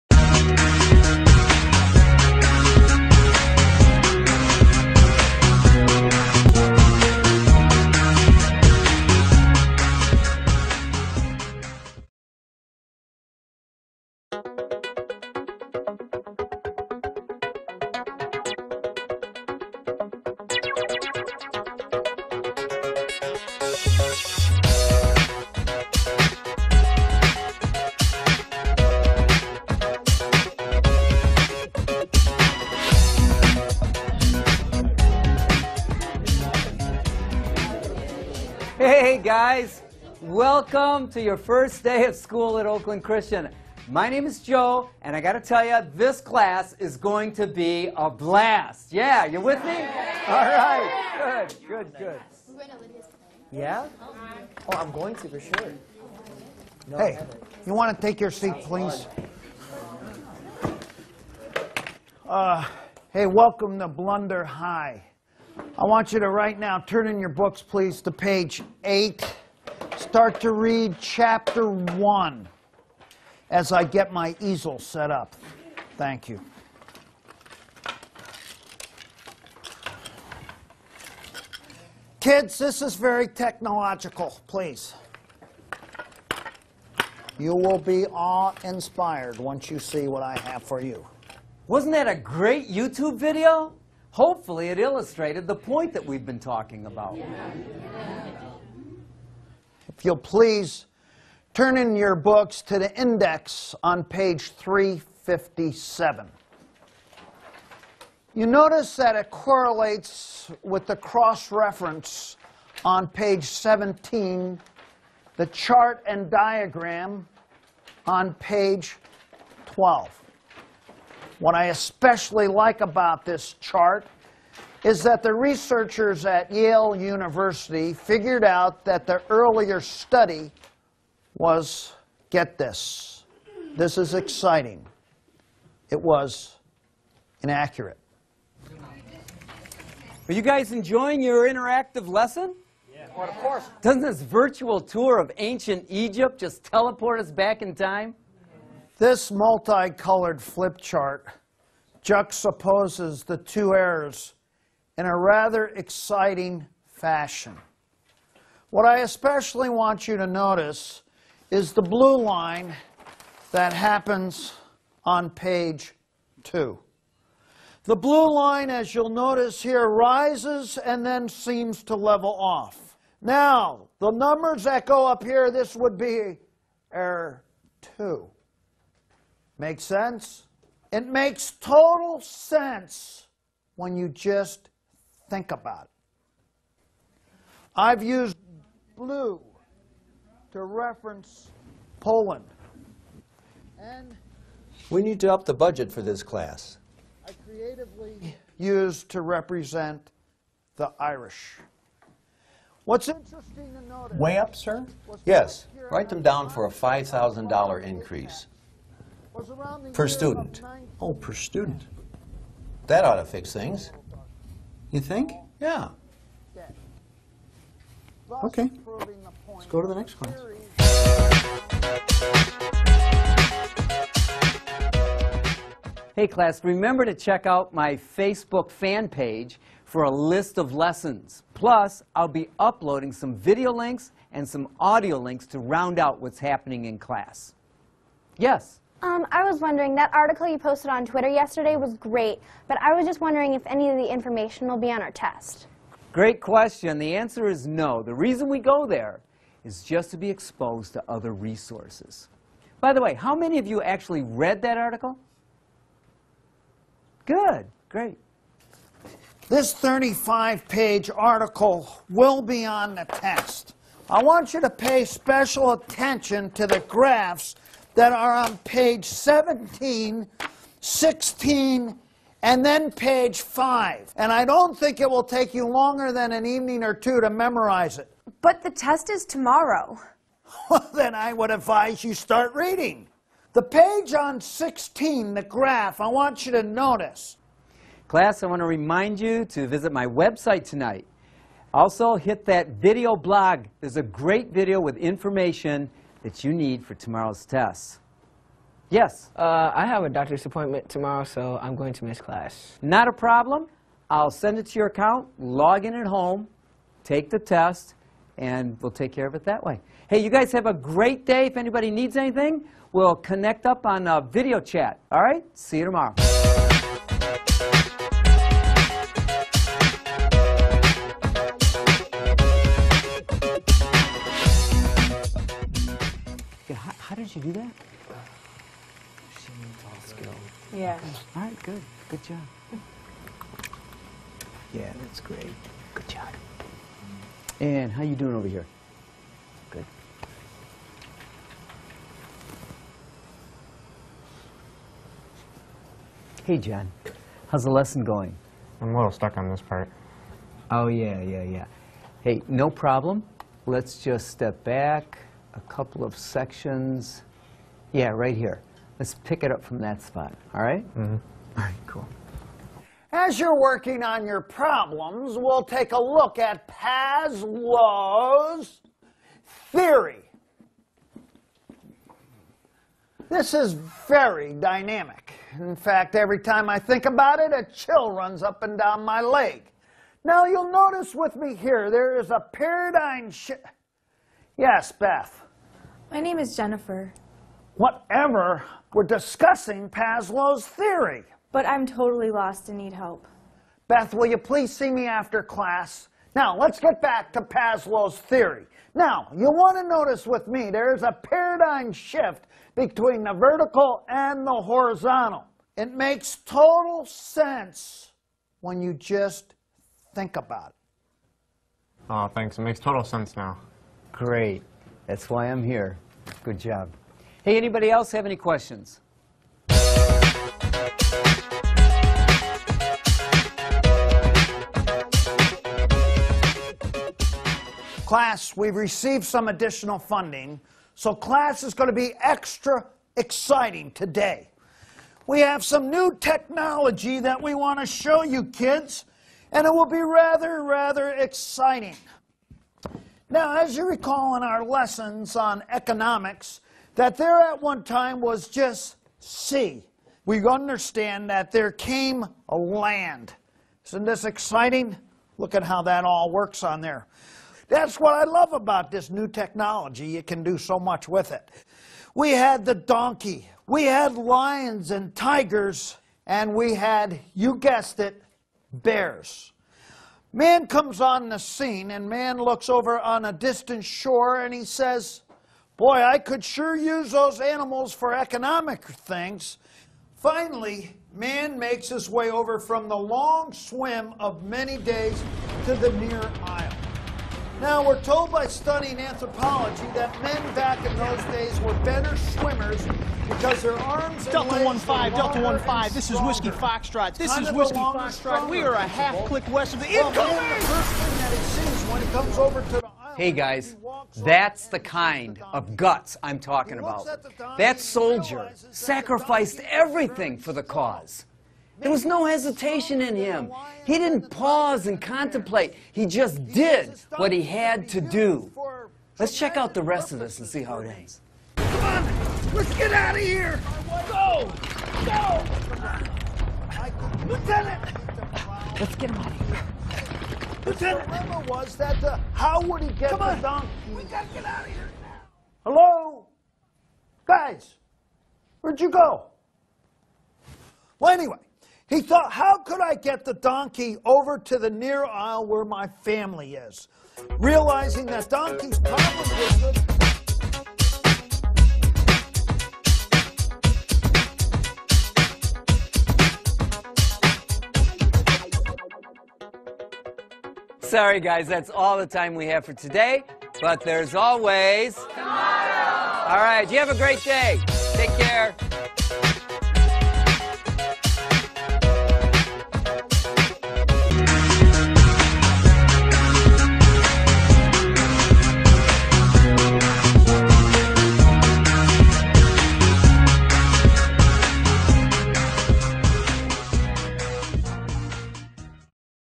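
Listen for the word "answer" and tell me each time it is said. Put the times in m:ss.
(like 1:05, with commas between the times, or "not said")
4:07.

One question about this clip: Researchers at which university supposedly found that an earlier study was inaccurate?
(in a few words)
Yale University.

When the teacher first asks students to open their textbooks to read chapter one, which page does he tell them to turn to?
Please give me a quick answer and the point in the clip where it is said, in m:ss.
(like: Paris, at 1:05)
8, at 1:08.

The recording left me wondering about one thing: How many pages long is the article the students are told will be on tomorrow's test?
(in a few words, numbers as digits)
35.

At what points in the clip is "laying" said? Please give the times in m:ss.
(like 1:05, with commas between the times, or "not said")
not said.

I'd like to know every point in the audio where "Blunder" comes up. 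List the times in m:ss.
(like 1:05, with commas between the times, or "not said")
1:03.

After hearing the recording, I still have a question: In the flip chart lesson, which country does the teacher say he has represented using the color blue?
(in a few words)
Poland.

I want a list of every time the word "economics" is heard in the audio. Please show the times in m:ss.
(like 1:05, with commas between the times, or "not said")
7:25, 7:58.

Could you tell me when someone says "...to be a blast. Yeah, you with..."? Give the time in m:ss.
0:47.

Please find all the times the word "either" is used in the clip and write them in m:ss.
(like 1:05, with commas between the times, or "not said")
not said.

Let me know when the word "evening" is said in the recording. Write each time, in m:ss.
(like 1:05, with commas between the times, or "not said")
4:36.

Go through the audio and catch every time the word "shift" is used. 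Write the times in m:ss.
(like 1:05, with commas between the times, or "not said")
6:23, 6:41.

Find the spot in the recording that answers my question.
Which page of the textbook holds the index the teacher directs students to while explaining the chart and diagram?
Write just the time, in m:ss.
1:44.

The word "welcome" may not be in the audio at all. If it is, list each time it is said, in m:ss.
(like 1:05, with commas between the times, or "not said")
0:40, 1:03.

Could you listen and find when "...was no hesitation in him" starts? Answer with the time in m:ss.
8:31.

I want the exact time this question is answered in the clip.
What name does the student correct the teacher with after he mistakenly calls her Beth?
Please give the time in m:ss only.
6:26.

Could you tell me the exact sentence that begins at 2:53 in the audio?
Now, the numbers that go up here, this would be error 2.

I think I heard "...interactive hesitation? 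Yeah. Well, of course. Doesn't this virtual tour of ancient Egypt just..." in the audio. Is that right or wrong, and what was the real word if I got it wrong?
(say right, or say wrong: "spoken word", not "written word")
wrong: "lesson", not "hesitation".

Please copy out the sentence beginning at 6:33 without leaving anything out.
Beth, will you please see me after class?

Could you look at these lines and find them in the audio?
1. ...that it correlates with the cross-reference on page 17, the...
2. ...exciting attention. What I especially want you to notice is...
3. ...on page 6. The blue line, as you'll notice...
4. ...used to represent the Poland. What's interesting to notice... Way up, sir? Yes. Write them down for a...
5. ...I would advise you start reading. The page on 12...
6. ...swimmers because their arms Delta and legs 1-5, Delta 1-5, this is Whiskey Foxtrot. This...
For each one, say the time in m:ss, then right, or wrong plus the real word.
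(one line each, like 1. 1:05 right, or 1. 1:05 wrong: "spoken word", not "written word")
1. 1:48 right
2. 2:35 wrong: "fashion", not "attention"
3. 2:45 wrong: "2", not "6"
4. 3:18 wrong: "Irish", not "Poland"
5. 4:41 wrong: "16", not "12"
6. 8:12 right.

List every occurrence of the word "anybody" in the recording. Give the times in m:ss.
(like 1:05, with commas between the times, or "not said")
5:11, 6:57.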